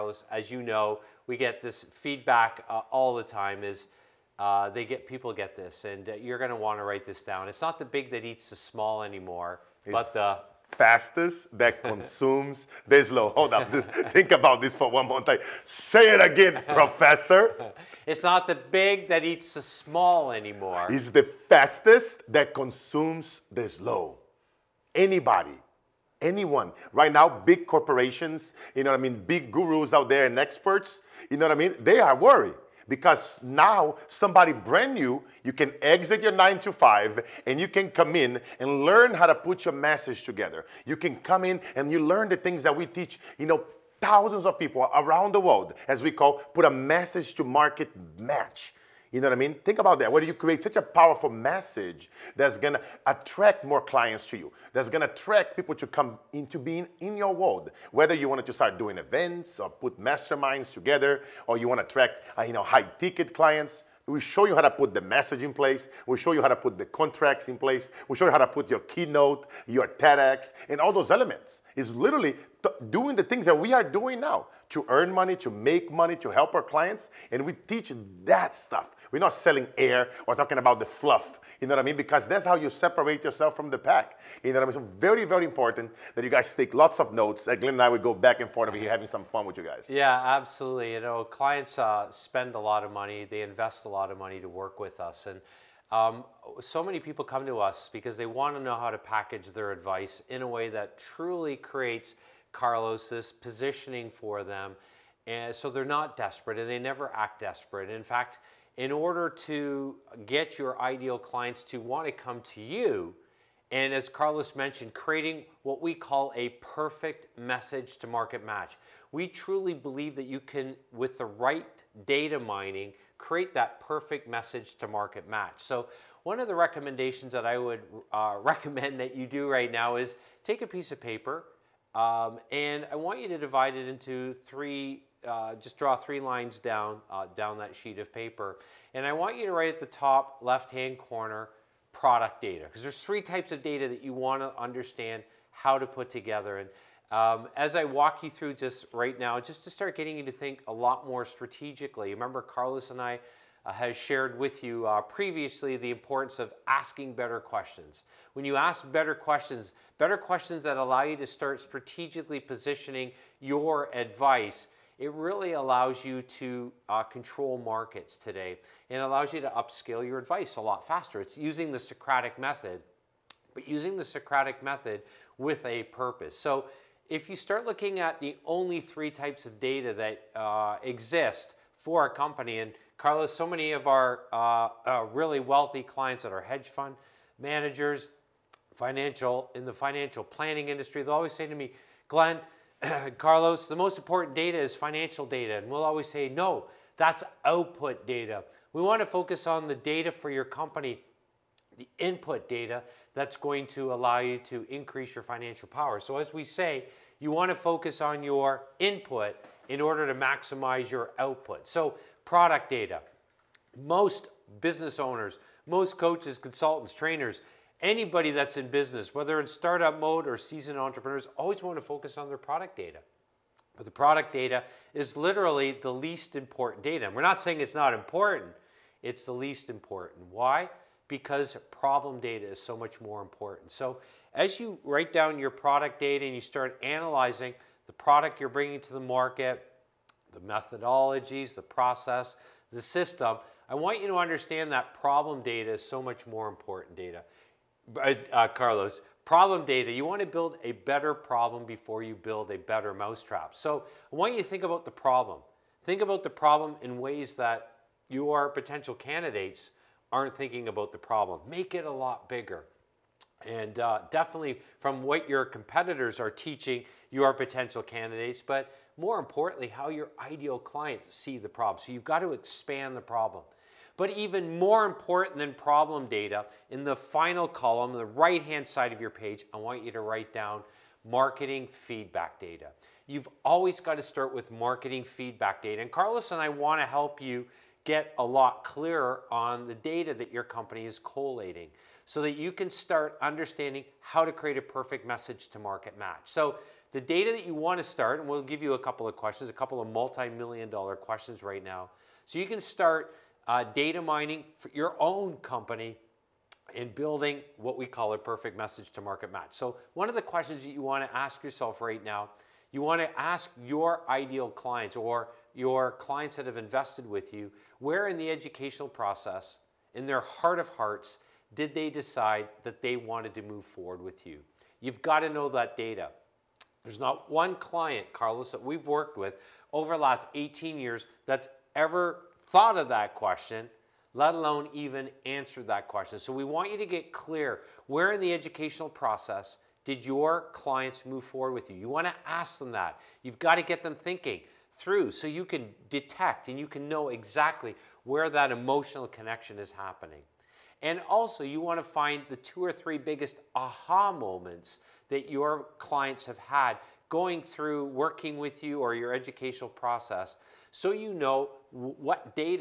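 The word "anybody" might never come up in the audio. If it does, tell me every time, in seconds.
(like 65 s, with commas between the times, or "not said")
24 s, 217 s.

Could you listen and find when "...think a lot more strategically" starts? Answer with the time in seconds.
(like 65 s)
150 s.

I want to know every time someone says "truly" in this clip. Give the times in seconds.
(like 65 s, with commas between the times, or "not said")
100 s, 119 s.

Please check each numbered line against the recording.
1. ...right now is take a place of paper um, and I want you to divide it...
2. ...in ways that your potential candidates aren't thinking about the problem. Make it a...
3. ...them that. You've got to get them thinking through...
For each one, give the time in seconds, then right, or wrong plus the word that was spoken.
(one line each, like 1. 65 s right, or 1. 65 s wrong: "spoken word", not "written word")
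1. 129 s wrong: "piece", not "place"
2. 256 s right
3. 342 s right.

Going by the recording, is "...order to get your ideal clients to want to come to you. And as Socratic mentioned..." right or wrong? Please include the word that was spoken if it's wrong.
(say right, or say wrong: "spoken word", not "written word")
wrong: "Carlos", not "Socratic".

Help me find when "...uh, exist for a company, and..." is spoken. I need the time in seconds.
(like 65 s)
180 s.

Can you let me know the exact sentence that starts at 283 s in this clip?
You've always got to start with marketing feedback data.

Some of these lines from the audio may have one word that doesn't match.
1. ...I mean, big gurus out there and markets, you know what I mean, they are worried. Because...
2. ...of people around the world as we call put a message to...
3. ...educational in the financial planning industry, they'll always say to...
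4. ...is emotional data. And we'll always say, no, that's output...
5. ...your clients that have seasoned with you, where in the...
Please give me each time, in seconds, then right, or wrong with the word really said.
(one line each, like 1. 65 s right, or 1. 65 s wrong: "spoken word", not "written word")
1. 28 s wrong: "experts", not "markets"
2. 44 s right
3. 188 s wrong: "financial", not "educational"
4. 194 s wrong: "financial", not "emotional"
5. 315 s wrong: "invested", not "seasoned".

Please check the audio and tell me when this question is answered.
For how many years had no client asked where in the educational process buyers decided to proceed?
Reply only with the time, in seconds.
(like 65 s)
330 s.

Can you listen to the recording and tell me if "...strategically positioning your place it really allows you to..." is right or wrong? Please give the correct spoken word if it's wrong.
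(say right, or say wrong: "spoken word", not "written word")
wrong: "advice", not "place".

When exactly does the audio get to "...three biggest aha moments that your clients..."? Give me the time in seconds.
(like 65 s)
352 s.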